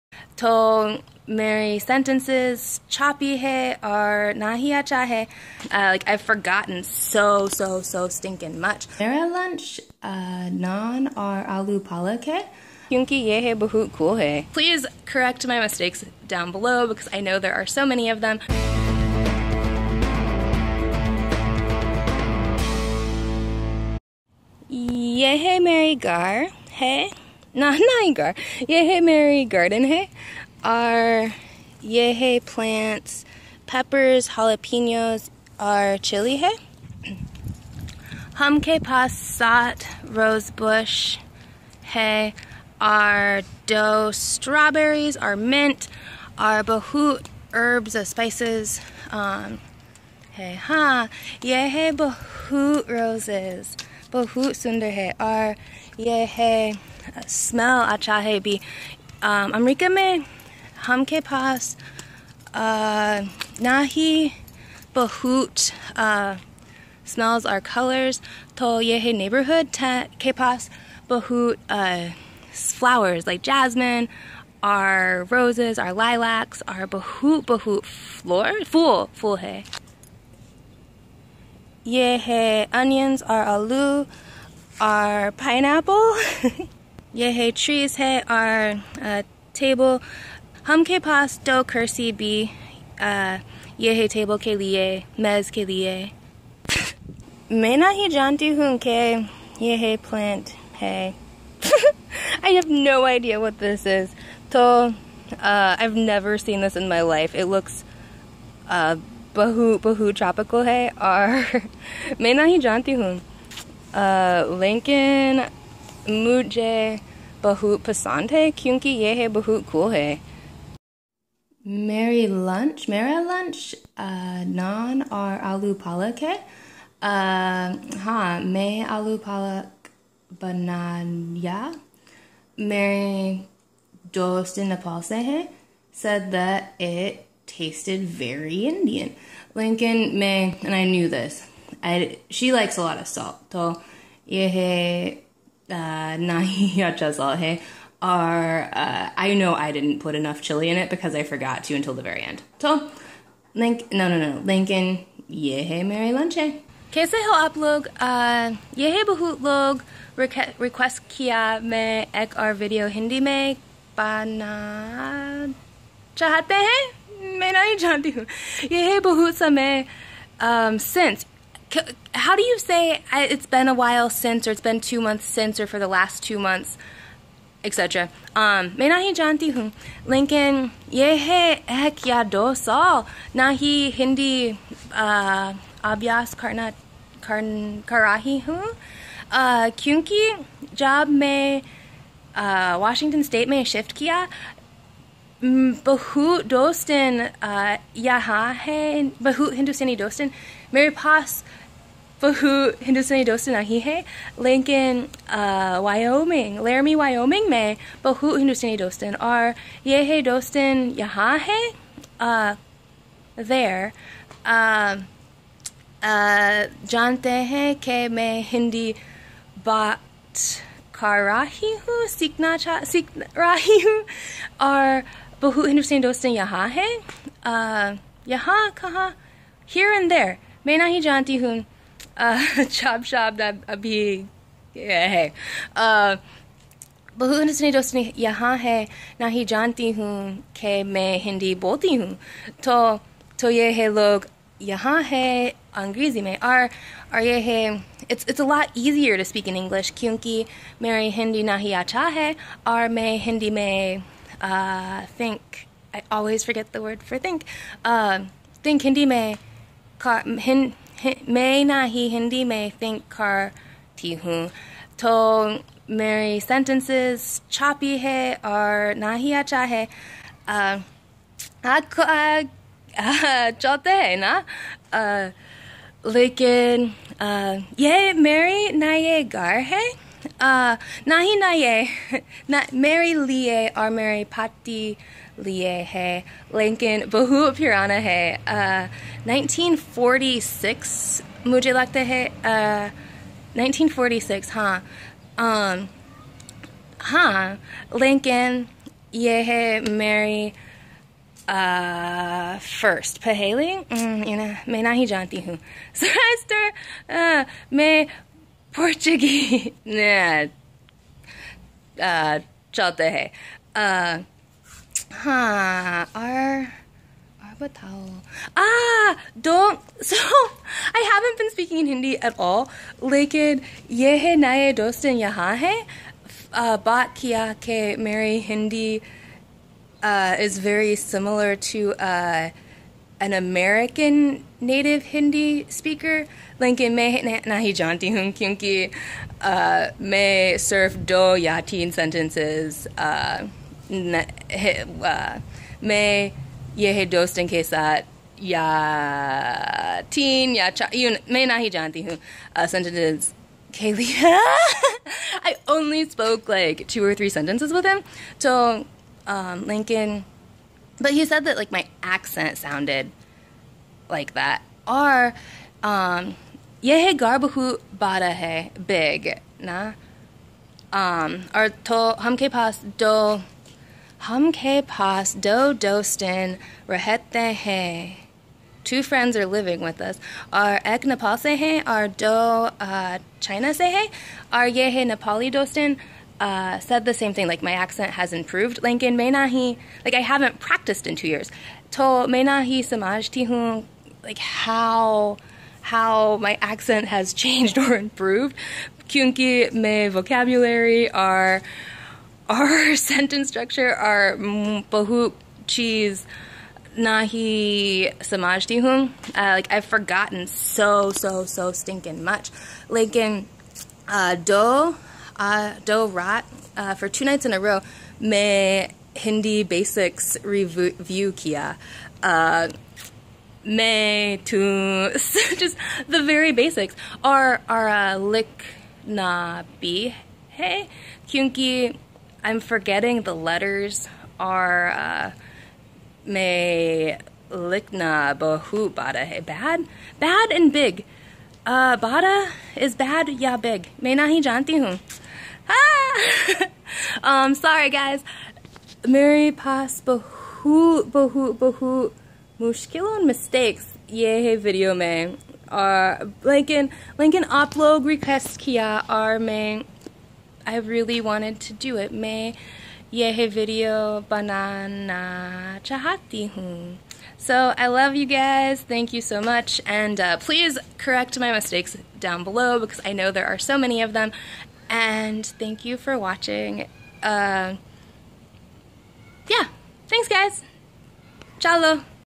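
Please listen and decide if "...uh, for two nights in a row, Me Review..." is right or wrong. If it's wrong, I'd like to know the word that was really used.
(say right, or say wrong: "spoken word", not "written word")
wrong: "Hindi", not "Review".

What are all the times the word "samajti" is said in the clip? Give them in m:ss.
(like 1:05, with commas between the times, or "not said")
6:32, 6:48.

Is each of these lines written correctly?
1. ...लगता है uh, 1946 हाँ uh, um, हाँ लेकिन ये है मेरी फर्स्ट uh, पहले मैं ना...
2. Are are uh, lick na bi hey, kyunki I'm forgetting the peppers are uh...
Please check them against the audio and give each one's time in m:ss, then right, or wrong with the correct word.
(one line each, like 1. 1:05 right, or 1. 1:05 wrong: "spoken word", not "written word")
1. 4:51 right
2. 7:07 wrong: "letters", not "peppers".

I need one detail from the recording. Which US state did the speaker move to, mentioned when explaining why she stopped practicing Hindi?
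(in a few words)
Washington.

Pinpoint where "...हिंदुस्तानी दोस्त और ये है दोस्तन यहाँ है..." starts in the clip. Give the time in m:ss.
3:28.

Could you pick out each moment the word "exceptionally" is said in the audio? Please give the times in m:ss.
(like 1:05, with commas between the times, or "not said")
not said.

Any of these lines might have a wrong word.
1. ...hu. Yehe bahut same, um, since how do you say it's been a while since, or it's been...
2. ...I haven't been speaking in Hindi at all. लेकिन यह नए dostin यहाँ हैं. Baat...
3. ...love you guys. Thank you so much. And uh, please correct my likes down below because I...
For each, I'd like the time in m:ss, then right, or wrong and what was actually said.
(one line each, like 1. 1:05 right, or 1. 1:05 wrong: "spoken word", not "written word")
1. 2:48 right
2. 5:20 right
3. 7:47 wrong: "mistakes", not "likes".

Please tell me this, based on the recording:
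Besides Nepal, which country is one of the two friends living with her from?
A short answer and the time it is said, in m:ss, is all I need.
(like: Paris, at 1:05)
China, at 6:23.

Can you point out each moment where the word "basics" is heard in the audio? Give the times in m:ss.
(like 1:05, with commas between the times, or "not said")
6:59, 7:06.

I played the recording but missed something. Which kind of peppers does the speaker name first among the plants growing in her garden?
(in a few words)
jalapenos.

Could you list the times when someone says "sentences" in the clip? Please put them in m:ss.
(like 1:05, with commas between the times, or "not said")
0:01, 4:26, 5:41, 5:52, 5:57, 6:42.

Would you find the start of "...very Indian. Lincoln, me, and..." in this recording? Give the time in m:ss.
2:18.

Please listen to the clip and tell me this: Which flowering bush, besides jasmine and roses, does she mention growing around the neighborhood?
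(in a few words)
lilacs.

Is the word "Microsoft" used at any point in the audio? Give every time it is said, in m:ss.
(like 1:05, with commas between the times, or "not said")
not said.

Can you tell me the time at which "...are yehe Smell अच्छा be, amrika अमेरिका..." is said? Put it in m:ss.
0:55.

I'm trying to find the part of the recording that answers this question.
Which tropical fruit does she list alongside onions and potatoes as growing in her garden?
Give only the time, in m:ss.
1:25.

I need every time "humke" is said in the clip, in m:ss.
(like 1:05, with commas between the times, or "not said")
0:38, 1:30.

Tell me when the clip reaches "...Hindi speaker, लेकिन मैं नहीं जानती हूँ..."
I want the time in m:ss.
5:35.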